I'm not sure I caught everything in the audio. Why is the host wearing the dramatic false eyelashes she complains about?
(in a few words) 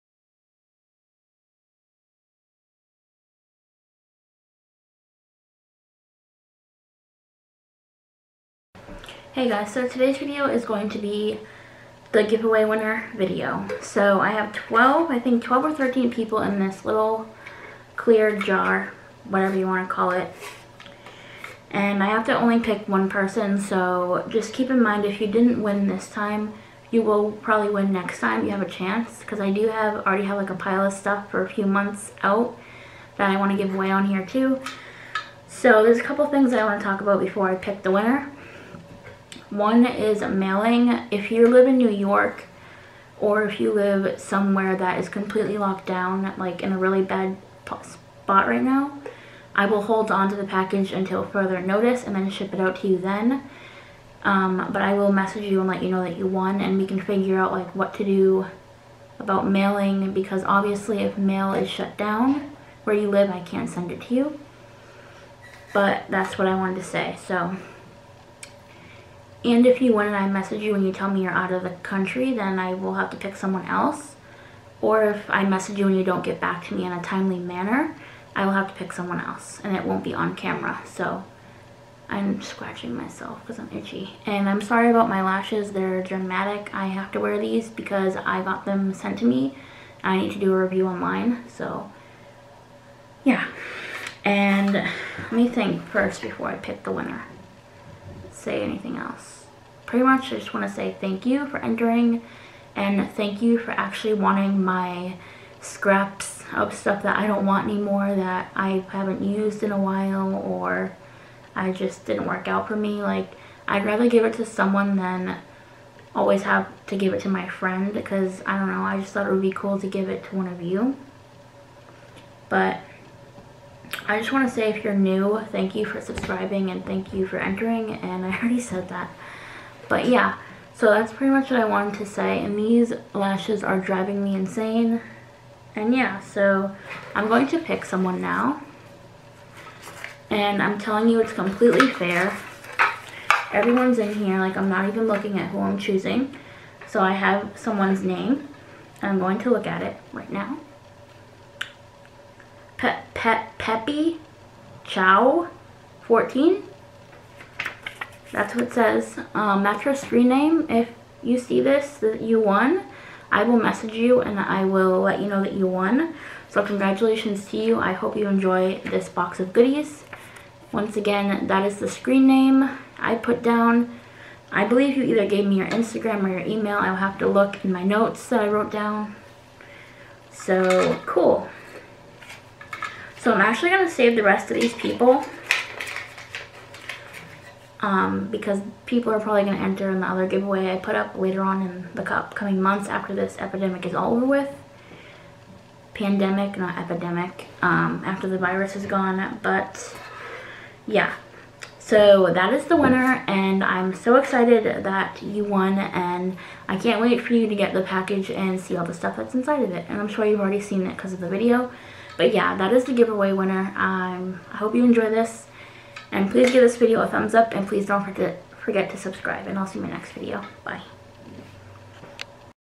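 to do a review.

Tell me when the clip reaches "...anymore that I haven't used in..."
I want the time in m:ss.
1:47.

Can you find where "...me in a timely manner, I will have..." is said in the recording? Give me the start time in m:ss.
1:16.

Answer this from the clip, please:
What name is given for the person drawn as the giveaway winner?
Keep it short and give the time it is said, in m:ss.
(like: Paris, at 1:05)
Peppy Chow 14, at 2:33.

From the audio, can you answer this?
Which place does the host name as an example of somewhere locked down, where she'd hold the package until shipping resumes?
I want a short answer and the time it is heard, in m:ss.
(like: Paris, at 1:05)
New York, at 0:41.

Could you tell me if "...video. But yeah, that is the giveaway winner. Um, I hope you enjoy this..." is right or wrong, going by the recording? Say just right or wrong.
right.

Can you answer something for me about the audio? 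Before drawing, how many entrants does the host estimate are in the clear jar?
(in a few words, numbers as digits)
12 or 13.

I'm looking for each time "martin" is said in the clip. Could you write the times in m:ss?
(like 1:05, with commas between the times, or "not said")
not said.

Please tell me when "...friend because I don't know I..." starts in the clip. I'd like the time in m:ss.
1:57.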